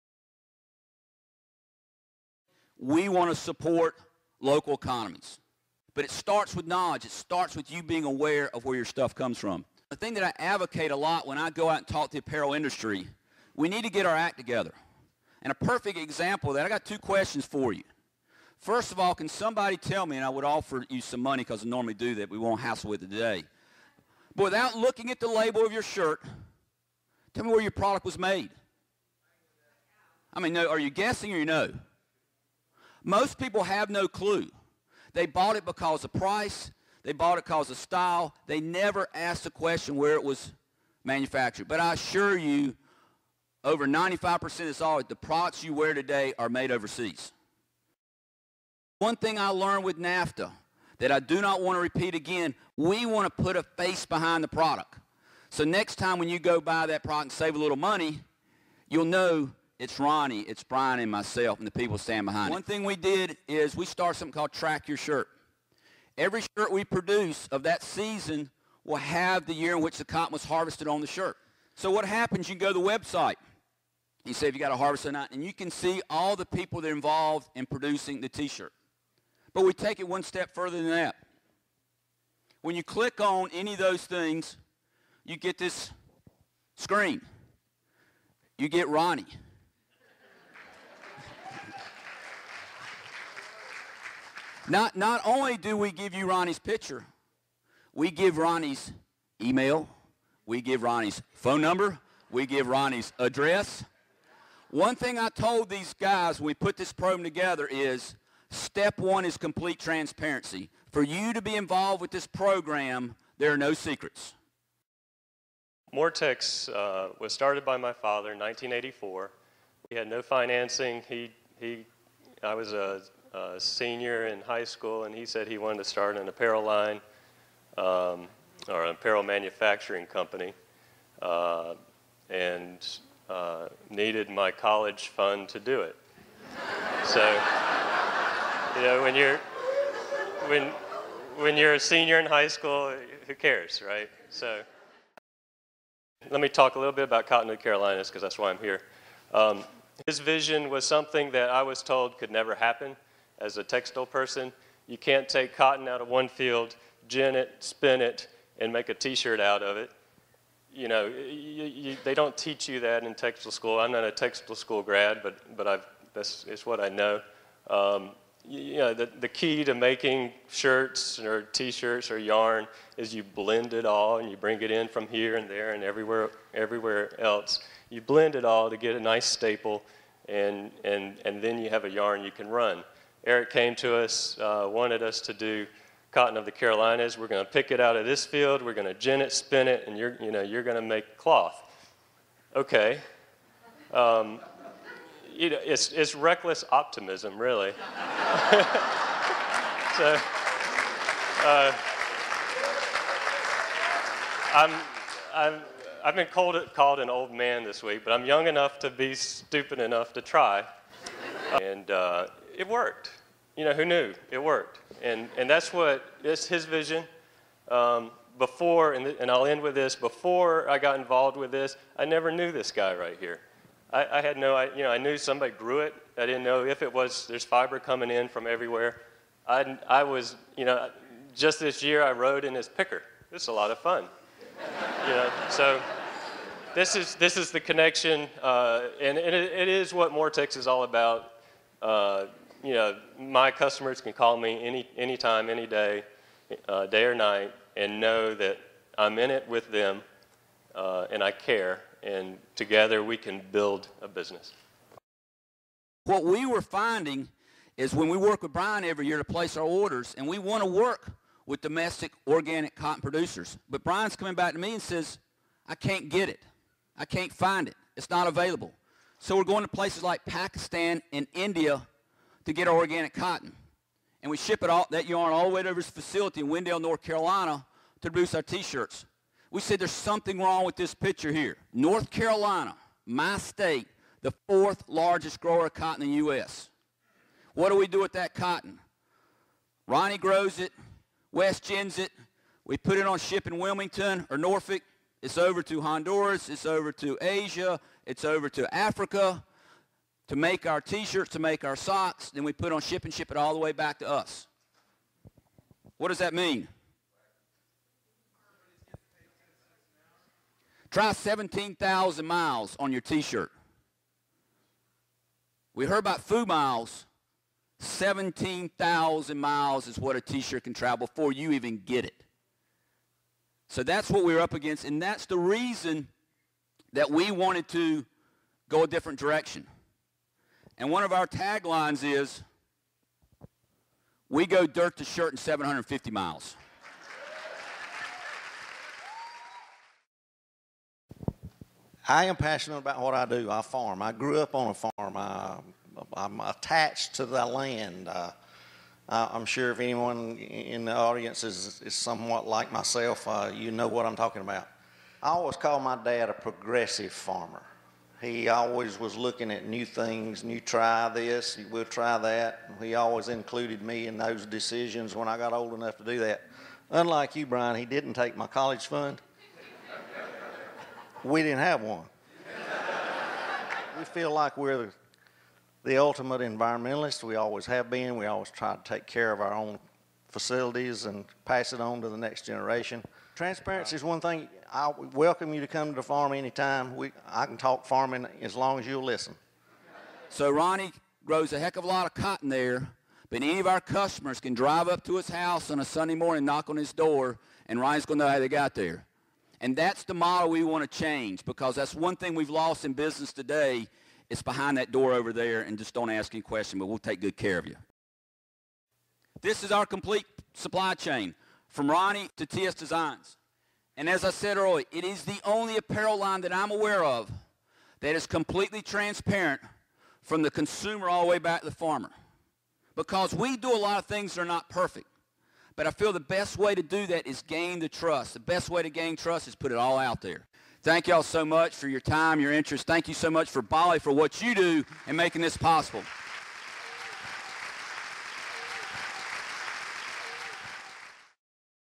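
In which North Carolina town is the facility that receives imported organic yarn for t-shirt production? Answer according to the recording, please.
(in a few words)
Wendell.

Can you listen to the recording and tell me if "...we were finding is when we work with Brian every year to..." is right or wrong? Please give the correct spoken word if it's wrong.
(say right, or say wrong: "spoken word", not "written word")
right.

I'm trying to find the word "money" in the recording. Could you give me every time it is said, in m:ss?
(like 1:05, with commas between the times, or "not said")
0:21, 0:57.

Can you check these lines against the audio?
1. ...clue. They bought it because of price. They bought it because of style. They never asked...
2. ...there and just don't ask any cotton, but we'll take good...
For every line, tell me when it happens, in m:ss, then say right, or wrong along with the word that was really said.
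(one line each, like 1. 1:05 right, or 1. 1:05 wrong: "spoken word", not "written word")
1. 0:34 right
2. 6:45 wrong: "question", not "cotton".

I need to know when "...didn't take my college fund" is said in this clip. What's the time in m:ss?
6:07.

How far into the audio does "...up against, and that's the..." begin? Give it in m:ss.
5:24.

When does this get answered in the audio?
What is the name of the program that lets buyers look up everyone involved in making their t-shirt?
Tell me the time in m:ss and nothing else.
1:04.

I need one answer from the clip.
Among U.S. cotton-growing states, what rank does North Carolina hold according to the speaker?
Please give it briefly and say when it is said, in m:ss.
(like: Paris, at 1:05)
fourth largest, at 4:44.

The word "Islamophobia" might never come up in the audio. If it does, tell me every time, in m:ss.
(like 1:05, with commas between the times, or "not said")
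not said.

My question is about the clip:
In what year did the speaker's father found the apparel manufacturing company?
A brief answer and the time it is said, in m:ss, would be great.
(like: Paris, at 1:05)
1984, at 1:58.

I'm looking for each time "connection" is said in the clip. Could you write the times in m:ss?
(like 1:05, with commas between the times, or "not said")
3:57.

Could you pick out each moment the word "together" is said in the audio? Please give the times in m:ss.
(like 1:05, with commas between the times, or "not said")
0:14, 1:47, 4:12.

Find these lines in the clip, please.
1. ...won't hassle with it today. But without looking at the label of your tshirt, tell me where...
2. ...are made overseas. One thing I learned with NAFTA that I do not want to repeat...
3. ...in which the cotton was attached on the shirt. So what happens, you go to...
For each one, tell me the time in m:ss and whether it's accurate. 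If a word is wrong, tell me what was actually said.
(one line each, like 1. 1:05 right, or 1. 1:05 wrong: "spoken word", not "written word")
1. 0:22 wrong: "shirt", not "tshirt"
2. 0:46 right
3. 1:09 wrong: "harvested", not "attached".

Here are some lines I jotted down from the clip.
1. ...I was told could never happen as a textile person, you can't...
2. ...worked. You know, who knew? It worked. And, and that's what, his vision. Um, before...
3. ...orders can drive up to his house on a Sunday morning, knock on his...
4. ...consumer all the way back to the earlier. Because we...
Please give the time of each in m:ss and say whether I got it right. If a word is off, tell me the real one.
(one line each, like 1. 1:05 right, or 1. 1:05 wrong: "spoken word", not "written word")
1. 2:31 right
2. 3:32 right
3. 6:33 wrong: "customers", not "orders"
4. 7:00 wrong: "farmer", not "earlier".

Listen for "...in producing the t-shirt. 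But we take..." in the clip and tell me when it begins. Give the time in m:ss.
1:17.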